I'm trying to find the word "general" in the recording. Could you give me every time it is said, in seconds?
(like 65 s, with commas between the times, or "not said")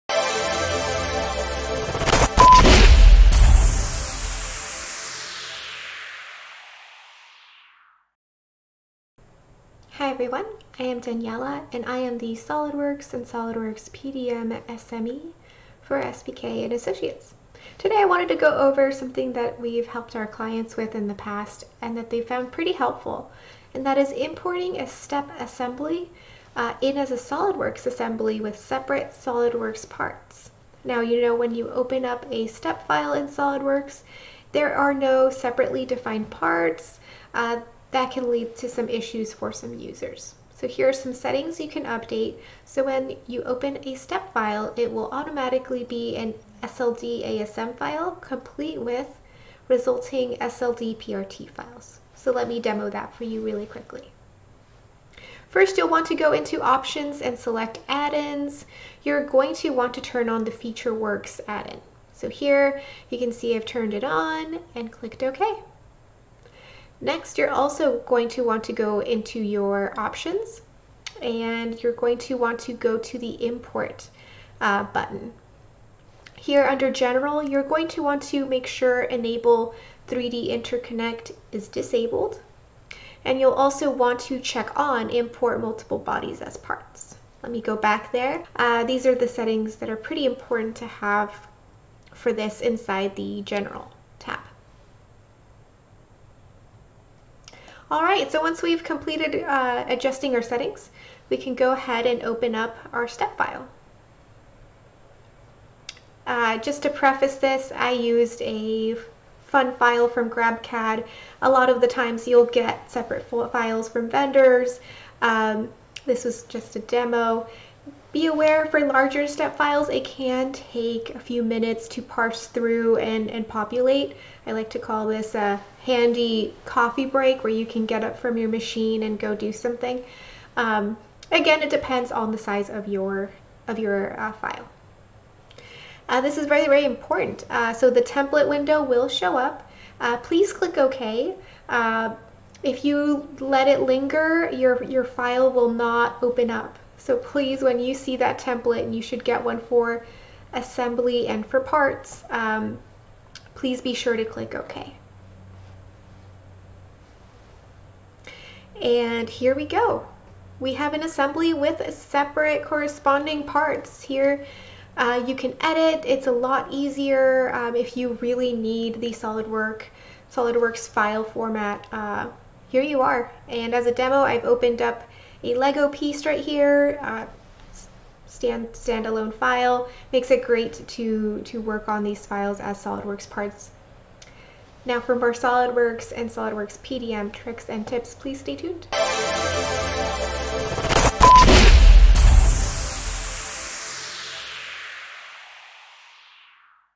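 76 s, 93 s.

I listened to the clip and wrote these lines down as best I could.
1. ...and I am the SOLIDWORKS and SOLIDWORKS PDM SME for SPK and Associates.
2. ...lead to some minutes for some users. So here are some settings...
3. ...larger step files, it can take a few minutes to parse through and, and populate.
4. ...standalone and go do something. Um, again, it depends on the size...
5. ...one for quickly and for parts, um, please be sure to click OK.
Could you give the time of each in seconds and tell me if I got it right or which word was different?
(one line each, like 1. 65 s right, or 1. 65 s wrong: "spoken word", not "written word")
1. 11 s right
2. 38 s wrong: "issues", not "minutes"
3. 118 s right
4. 128 s wrong: "machine", not "standalone"
5. 149 s wrong: "assembly", not "quickly".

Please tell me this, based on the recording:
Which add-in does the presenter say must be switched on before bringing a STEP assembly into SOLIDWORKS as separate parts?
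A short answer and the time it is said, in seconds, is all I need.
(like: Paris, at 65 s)
FeatureWorks, at 60 s.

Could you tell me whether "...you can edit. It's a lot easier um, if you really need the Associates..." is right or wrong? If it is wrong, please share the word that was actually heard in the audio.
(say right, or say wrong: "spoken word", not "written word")
wrong: "SolidWorks", not "Associates".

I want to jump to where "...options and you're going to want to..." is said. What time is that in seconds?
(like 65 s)
69 s.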